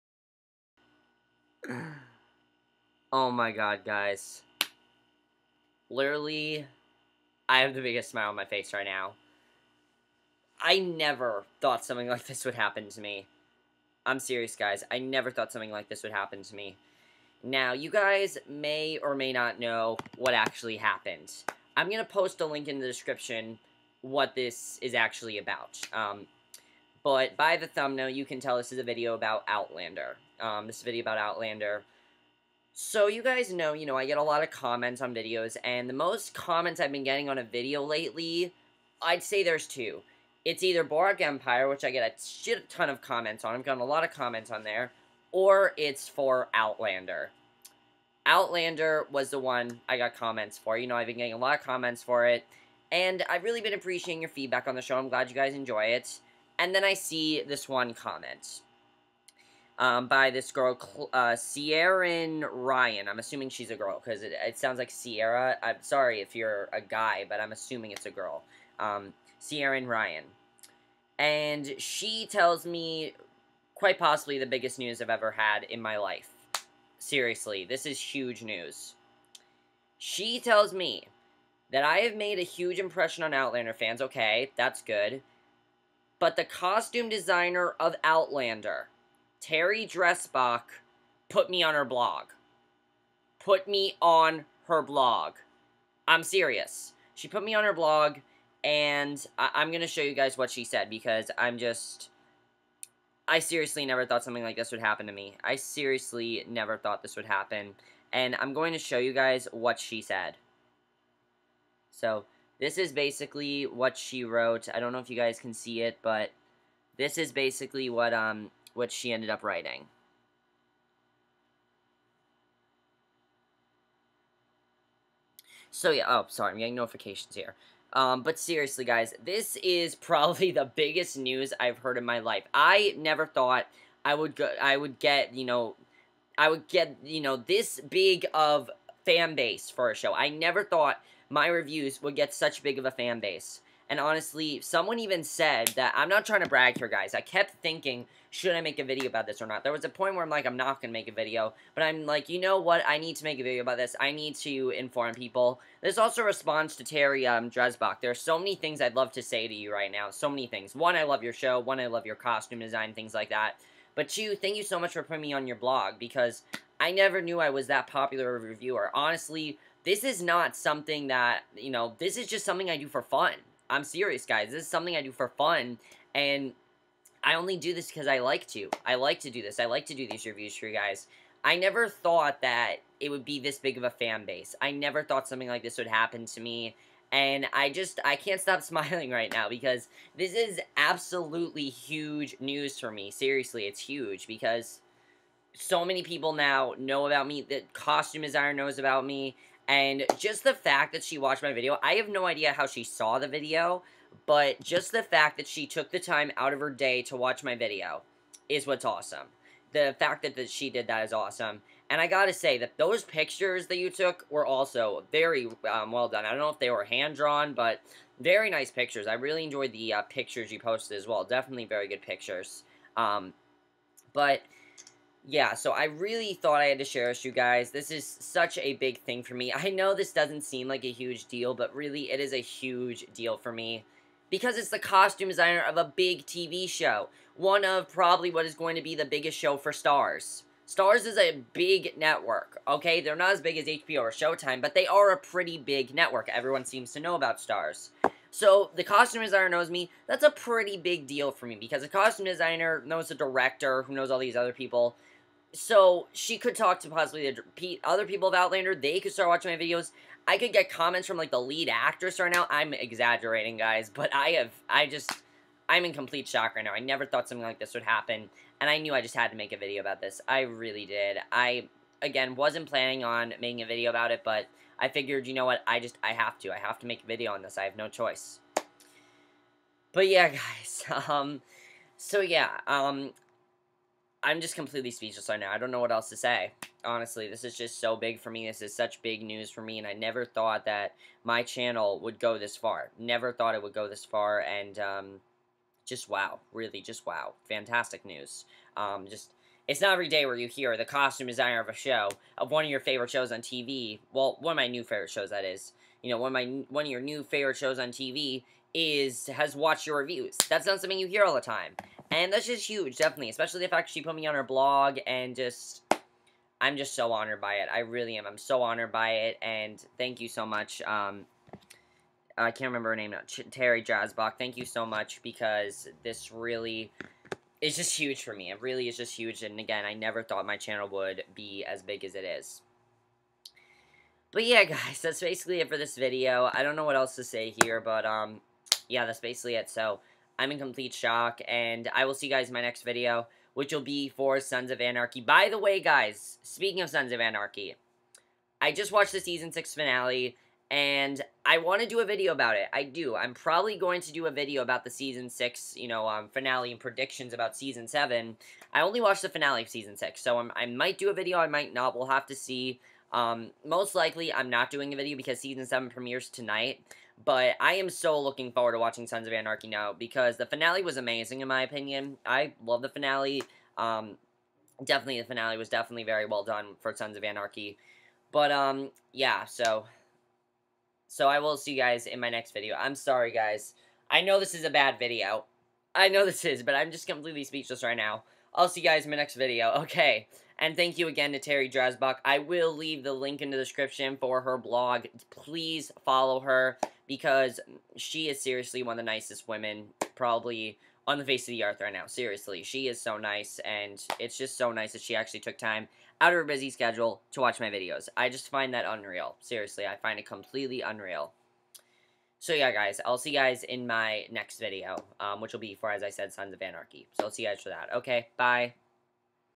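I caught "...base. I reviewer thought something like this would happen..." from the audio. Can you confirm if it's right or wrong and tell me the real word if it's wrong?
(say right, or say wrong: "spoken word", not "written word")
wrong: "never", not "reviewer".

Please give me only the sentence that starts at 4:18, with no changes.
They could start watching my videos.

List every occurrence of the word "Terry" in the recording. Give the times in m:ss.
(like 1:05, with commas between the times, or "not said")
1:29, 2:36, 5:23, 6:31.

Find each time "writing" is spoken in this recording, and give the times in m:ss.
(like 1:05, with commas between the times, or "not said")
1:59.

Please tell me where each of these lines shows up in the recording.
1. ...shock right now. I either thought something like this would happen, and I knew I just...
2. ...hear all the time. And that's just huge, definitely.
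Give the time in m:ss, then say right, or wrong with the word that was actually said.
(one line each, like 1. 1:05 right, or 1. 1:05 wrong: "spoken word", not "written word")
1. 4:26 wrong: "never", not "either"
2. 5:11 right.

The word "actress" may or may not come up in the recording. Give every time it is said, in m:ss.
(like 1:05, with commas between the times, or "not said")
4:21.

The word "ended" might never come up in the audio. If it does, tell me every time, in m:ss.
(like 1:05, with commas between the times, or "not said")
1:59.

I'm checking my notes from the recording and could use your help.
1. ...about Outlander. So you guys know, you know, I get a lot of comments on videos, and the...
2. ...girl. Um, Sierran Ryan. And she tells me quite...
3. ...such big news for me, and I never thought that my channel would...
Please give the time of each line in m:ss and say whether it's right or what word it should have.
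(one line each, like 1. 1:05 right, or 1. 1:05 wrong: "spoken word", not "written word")
1. 0:31 right
2. 1:08 right
3. 4:48 right.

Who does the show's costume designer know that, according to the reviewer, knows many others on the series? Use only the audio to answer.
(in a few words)
The director.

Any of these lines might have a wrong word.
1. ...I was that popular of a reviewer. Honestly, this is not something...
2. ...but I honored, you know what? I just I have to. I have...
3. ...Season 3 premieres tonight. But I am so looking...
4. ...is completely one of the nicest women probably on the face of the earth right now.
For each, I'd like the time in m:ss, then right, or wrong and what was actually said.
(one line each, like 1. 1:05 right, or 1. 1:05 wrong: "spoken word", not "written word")
1. 2:47 right
2. 4:34 wrong: "figured", not "honored"
3. 6:05 wrong: "7", not "3"
4. 6:38 wrong: "seriously", not "completely".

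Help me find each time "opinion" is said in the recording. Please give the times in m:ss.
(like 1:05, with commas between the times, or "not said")
6:11.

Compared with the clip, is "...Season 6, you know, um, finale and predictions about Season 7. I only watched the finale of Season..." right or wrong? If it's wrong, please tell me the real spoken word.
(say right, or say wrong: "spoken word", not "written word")
right.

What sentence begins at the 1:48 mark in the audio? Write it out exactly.
And I'm going to show you guys what she said.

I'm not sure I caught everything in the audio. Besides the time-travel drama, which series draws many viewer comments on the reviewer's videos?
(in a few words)
Boardwalk Empire.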